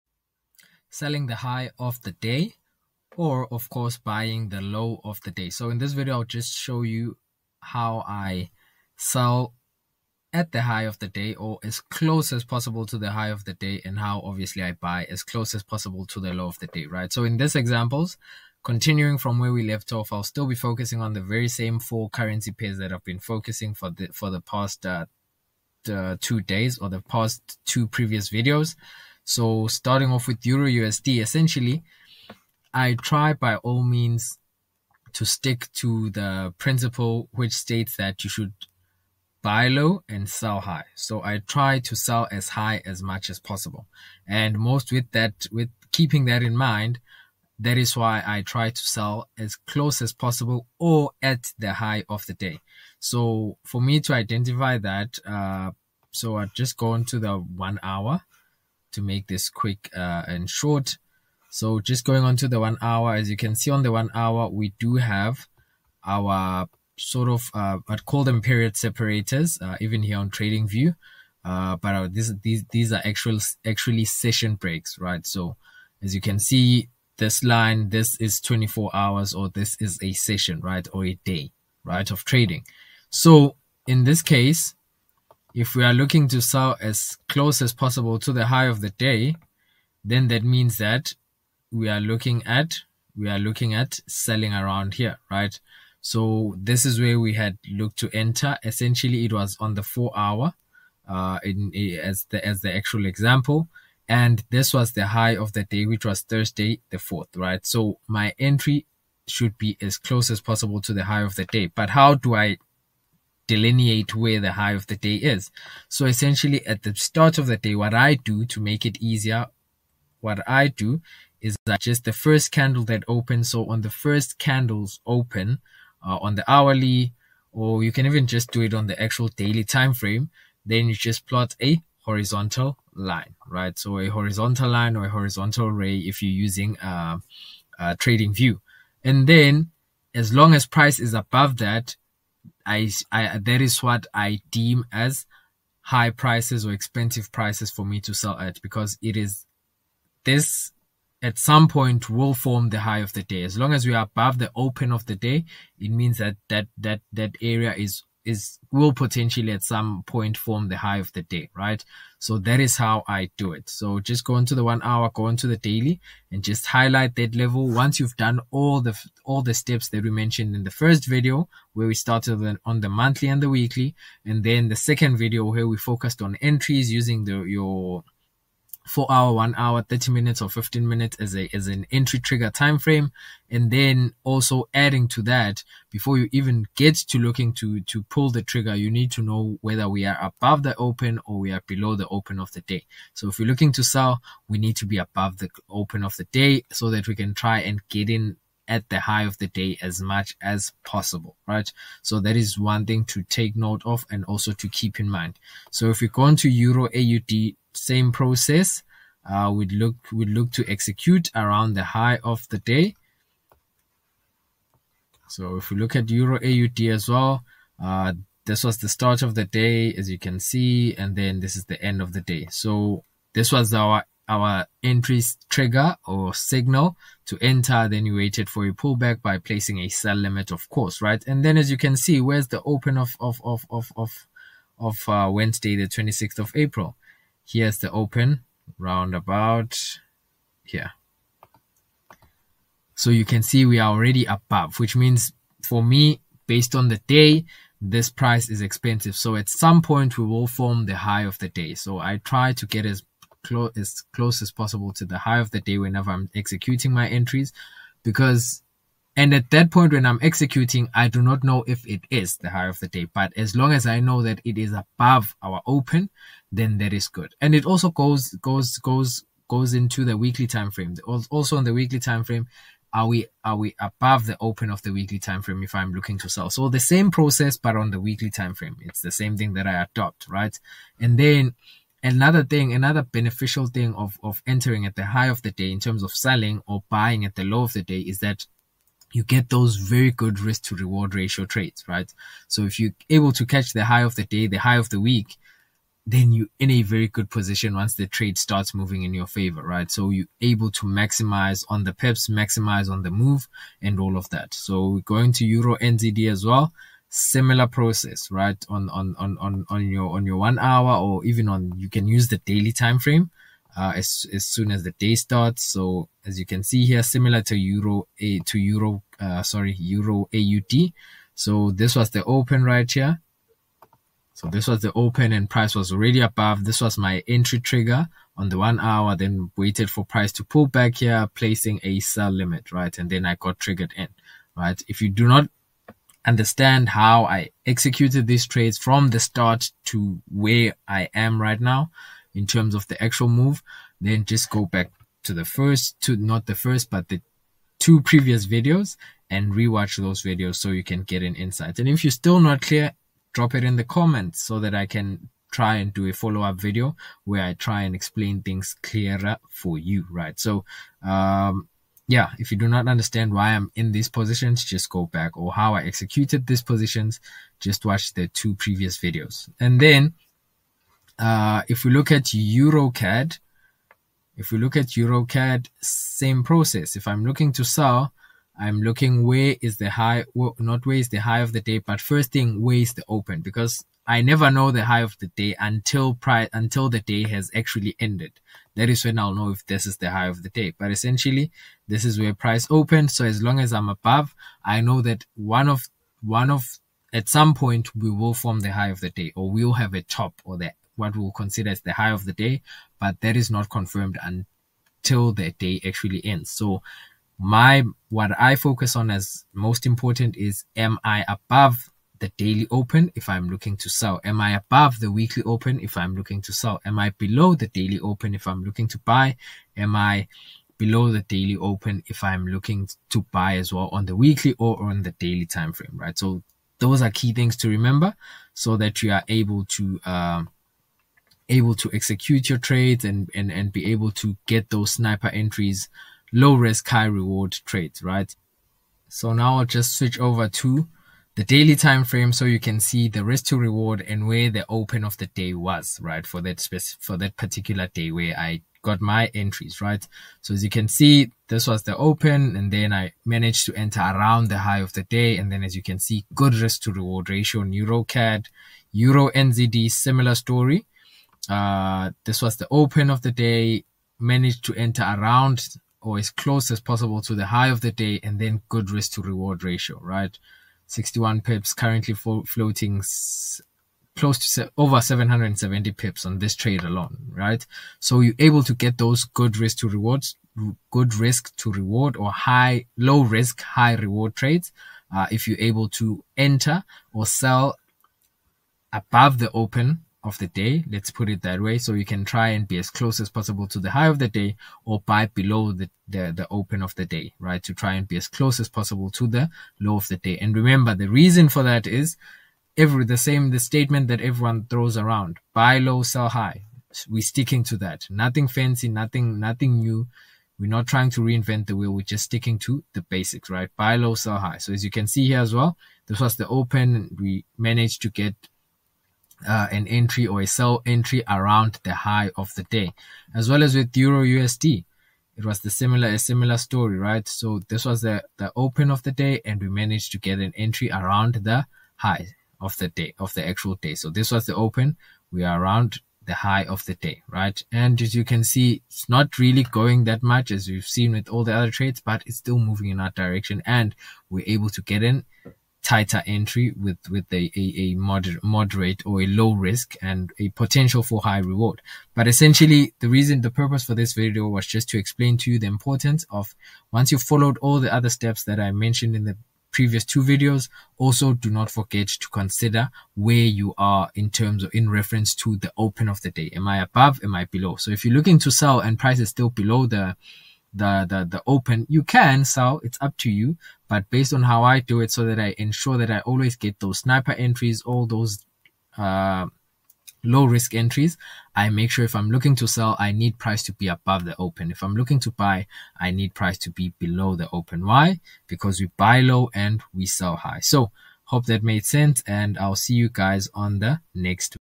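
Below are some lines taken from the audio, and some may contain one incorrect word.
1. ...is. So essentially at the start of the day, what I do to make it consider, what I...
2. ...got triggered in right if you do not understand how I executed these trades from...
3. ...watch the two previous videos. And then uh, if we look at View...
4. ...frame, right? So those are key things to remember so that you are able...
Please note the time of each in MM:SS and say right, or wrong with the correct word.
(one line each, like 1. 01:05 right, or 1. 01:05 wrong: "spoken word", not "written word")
1. 01:55 wrong: "easier", not "consider"
2. 05:33 right
3. 06:07 wrong: "EuroCAD", not "View"
4. 07:05 right.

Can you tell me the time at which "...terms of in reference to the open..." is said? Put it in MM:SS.
09:24.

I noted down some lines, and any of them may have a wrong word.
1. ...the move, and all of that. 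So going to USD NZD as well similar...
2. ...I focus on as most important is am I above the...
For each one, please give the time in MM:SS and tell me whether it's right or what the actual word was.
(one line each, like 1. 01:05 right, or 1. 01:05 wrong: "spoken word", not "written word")
1. 05:03 wrong: "Euro", not "USD"
2. 06:48 right.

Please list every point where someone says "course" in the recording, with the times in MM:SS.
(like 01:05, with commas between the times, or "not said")
00:03, 03:50.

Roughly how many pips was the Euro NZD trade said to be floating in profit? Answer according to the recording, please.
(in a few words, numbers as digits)
Over 770.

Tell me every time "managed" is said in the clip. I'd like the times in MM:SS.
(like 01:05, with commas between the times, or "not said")
07:33, 07:44, 08:37, 08:49.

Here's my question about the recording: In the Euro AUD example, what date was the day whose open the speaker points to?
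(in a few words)
Wednesday 26th April.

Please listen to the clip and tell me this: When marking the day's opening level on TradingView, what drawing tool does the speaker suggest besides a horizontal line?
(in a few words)
Horizontal ray.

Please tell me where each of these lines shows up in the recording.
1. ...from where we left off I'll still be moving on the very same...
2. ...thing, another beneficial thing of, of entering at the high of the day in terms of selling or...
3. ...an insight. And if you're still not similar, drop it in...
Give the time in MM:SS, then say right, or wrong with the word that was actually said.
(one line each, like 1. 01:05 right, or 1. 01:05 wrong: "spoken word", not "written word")
1. 00:19 wrong: "focusing", not "moving"
2. 04:42 right
3. 05:51 wrong: "clear", not "similar".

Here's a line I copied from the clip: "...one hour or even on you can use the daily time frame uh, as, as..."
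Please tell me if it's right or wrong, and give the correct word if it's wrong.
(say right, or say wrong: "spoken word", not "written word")
right.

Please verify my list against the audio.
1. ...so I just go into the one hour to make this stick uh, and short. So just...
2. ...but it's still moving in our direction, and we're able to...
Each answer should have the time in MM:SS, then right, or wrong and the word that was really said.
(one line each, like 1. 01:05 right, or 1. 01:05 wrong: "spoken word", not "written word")
1. 00:56 wrong: "quick", not "stick"
2. 09:01 right.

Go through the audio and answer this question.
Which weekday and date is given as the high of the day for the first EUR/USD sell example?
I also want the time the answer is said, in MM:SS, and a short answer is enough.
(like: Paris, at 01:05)
Thursday the 4th, at 01:46.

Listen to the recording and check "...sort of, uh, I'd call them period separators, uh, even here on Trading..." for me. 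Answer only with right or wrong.
right.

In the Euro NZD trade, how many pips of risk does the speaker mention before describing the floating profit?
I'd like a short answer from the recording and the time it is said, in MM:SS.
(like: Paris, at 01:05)
61, at 07:50.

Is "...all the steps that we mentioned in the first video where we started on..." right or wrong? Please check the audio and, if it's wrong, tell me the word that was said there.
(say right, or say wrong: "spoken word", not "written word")
right.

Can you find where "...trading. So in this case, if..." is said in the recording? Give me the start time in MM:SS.
01:22.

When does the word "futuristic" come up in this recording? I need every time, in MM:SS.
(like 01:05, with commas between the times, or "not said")
not said.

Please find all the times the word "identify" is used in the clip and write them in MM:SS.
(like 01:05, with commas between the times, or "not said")
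00:54.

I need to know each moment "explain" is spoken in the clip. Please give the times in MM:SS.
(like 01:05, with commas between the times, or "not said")
05:57, 09:14.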